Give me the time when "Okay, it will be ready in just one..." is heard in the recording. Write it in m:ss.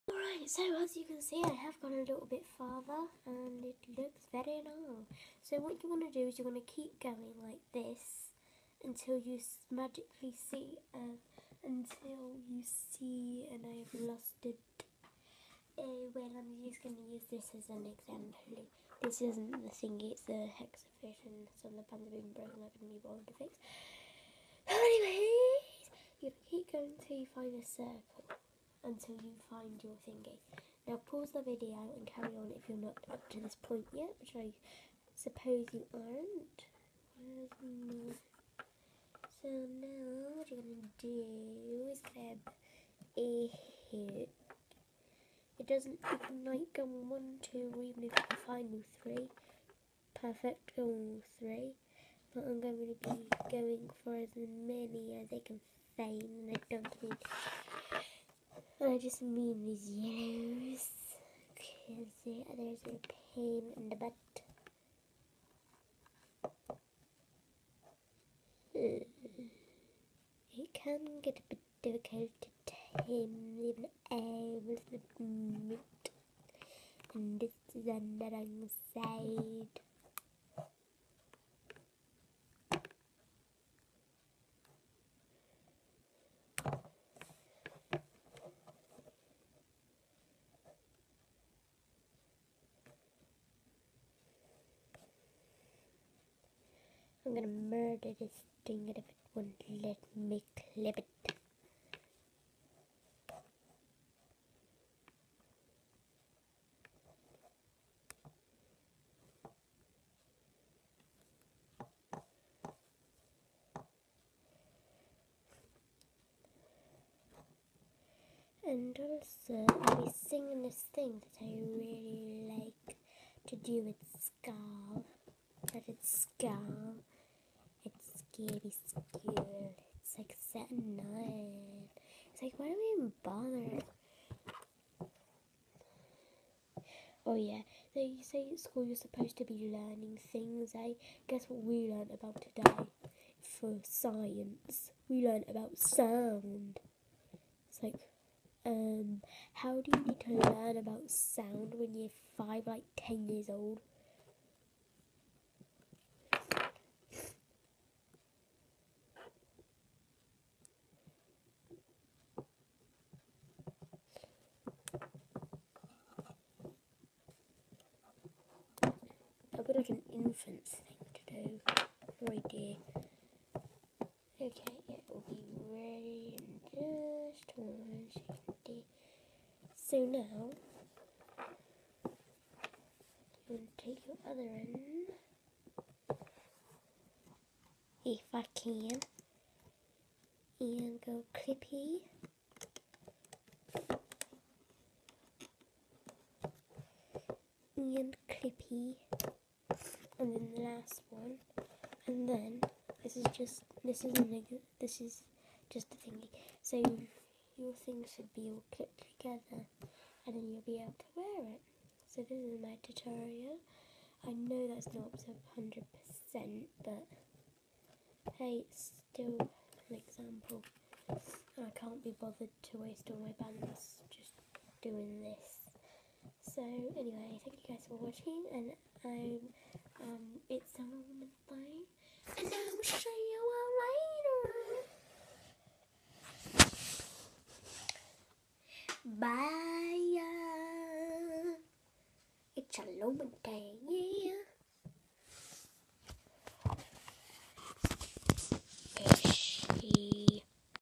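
2:54.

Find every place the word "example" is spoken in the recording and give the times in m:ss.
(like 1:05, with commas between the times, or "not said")
0:17, 3:40.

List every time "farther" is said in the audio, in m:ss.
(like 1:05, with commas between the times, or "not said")
0:02.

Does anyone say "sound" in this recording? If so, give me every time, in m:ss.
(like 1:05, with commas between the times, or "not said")
2:25, 2:31.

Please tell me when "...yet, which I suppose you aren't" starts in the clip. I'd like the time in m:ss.
0:33.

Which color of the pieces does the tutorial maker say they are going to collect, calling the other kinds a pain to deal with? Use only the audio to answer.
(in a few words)
yellows.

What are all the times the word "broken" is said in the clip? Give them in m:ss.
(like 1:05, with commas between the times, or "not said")
0:22.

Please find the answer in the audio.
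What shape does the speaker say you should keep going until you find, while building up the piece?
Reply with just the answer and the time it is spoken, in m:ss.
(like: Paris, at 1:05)
circle, at 0:27.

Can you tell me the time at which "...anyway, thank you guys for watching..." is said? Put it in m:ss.
3:46.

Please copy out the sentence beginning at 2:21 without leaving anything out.
Guess what we learned about today?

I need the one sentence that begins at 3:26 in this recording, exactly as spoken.
So your things should be all clipped together, and then you'll be able to wear it.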